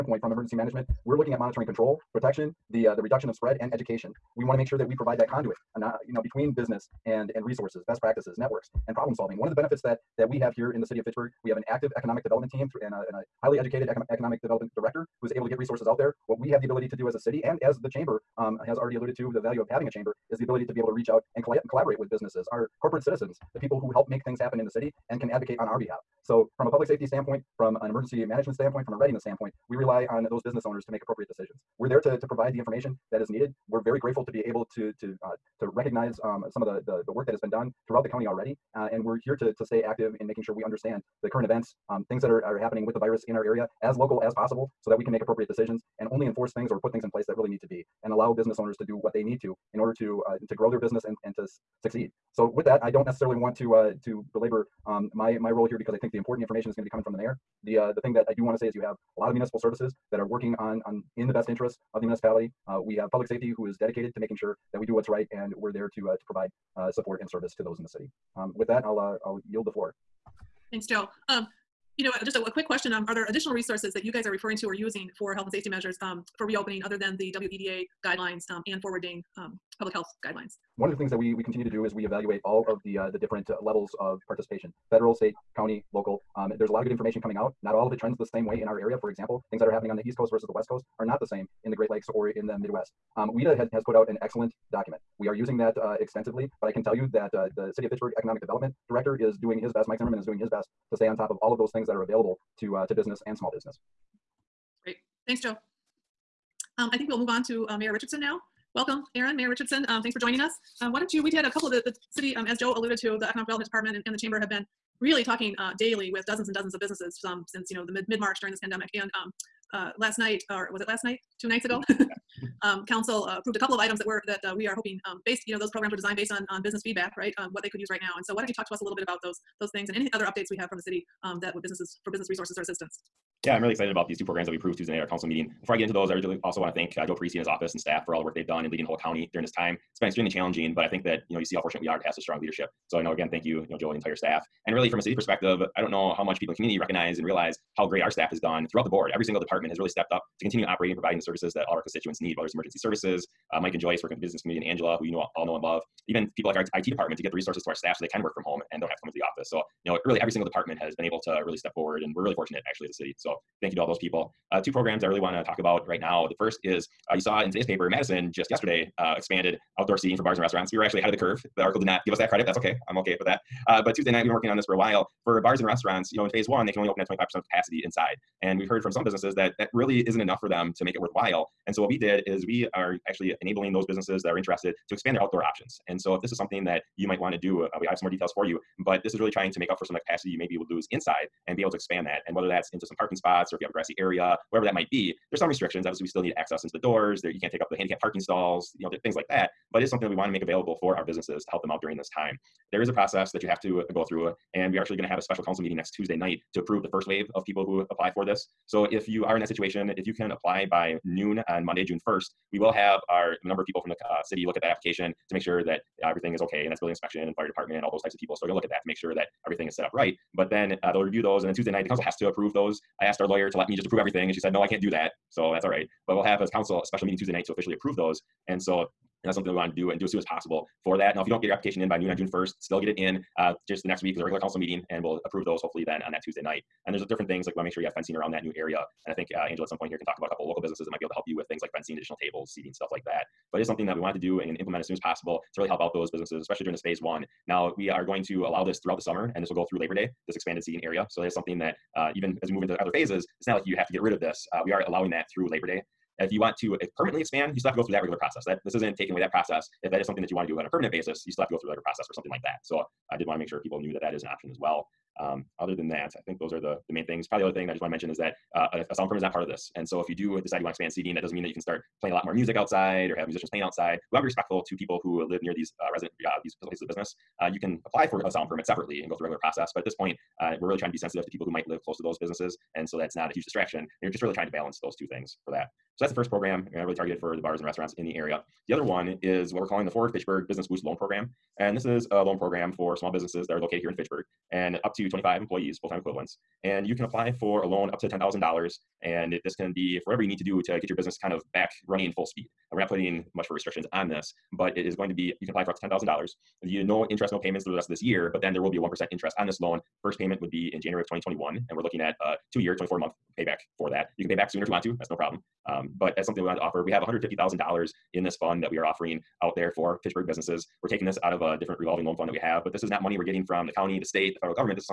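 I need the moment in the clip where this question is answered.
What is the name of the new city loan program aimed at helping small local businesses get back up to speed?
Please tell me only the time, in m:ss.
4:49.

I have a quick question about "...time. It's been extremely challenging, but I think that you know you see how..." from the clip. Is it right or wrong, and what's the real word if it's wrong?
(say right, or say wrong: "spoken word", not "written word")
right.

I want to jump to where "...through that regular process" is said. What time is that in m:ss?
4:17.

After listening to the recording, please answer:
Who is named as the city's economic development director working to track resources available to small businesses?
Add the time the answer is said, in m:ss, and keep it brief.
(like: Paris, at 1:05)
Mike Zimmerman, at 1:39.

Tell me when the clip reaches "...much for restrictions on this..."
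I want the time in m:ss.
5:03.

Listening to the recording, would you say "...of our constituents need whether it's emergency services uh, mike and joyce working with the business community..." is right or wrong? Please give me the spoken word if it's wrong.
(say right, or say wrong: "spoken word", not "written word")
right.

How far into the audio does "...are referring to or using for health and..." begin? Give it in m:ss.
1:14.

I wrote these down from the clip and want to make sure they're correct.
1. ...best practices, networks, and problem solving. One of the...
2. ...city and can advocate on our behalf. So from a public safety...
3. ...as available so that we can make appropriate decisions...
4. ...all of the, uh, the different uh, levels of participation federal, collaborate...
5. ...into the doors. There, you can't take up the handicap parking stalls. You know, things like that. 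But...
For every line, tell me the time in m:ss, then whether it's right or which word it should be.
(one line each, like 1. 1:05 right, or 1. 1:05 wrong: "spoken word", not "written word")
1. 0:07 right
2. 0:24 right
3. 0:44 wrong: "possible", not "available"
4. 1:22 wrong: "state", not "collaborate"
5. 3:16 right.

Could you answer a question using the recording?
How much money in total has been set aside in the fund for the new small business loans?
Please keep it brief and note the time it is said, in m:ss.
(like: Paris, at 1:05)
$150,000, at 5:17.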